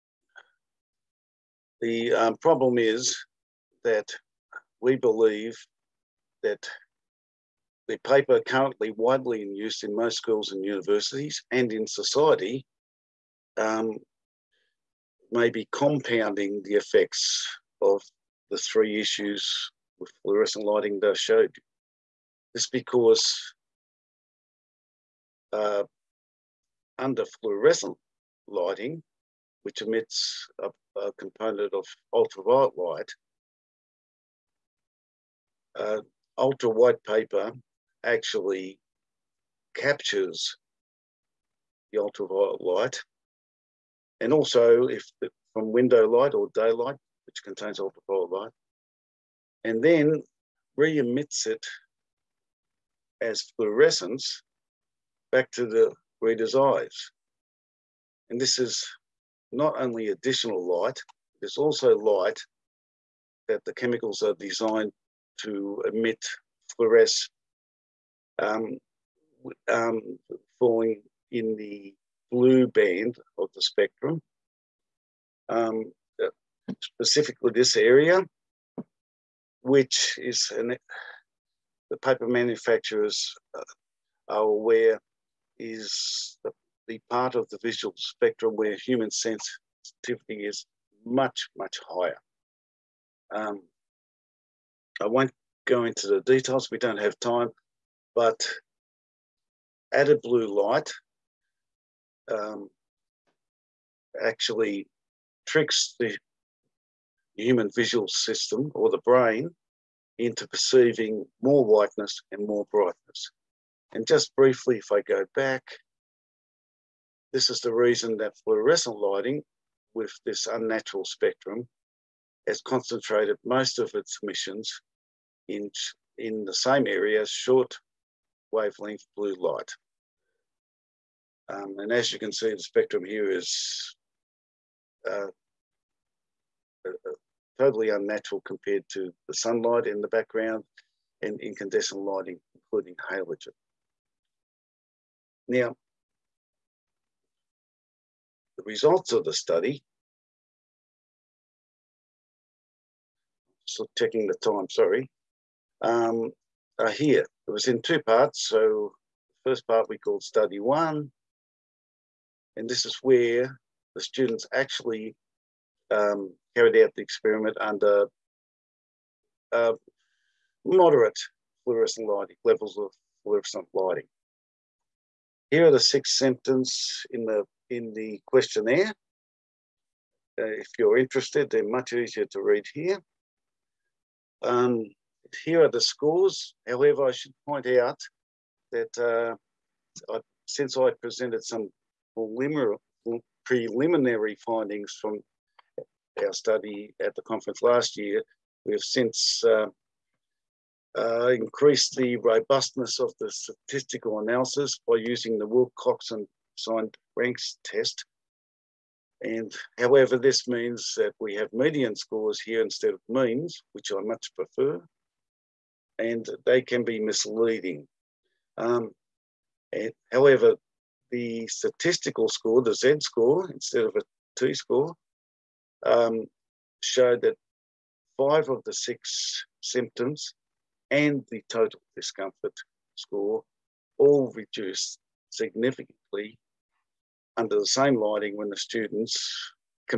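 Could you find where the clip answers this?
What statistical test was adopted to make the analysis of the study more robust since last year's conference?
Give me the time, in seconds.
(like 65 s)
205 s.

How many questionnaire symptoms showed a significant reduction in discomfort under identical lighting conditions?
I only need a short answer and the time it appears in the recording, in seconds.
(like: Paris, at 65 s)
5, at 228 s.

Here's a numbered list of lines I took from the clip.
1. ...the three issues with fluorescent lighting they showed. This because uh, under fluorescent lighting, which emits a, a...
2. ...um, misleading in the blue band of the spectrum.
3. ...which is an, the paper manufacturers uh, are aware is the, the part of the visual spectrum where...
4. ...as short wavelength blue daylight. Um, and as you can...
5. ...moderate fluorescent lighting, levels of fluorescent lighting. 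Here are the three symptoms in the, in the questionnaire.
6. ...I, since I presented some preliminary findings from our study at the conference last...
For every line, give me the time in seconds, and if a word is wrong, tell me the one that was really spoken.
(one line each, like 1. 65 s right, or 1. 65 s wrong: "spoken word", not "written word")
1. 18 s right
2. 69 s wrong: "falling", not "misleading"
3. 79 s right
4. 127 s wrong: "light", not "daylight"
5. 170 s wrong: "six", not "three"
6. 190 s right.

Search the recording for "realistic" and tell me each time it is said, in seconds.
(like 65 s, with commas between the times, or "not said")
not said.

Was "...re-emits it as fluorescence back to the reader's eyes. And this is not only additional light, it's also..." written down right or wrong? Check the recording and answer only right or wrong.
right.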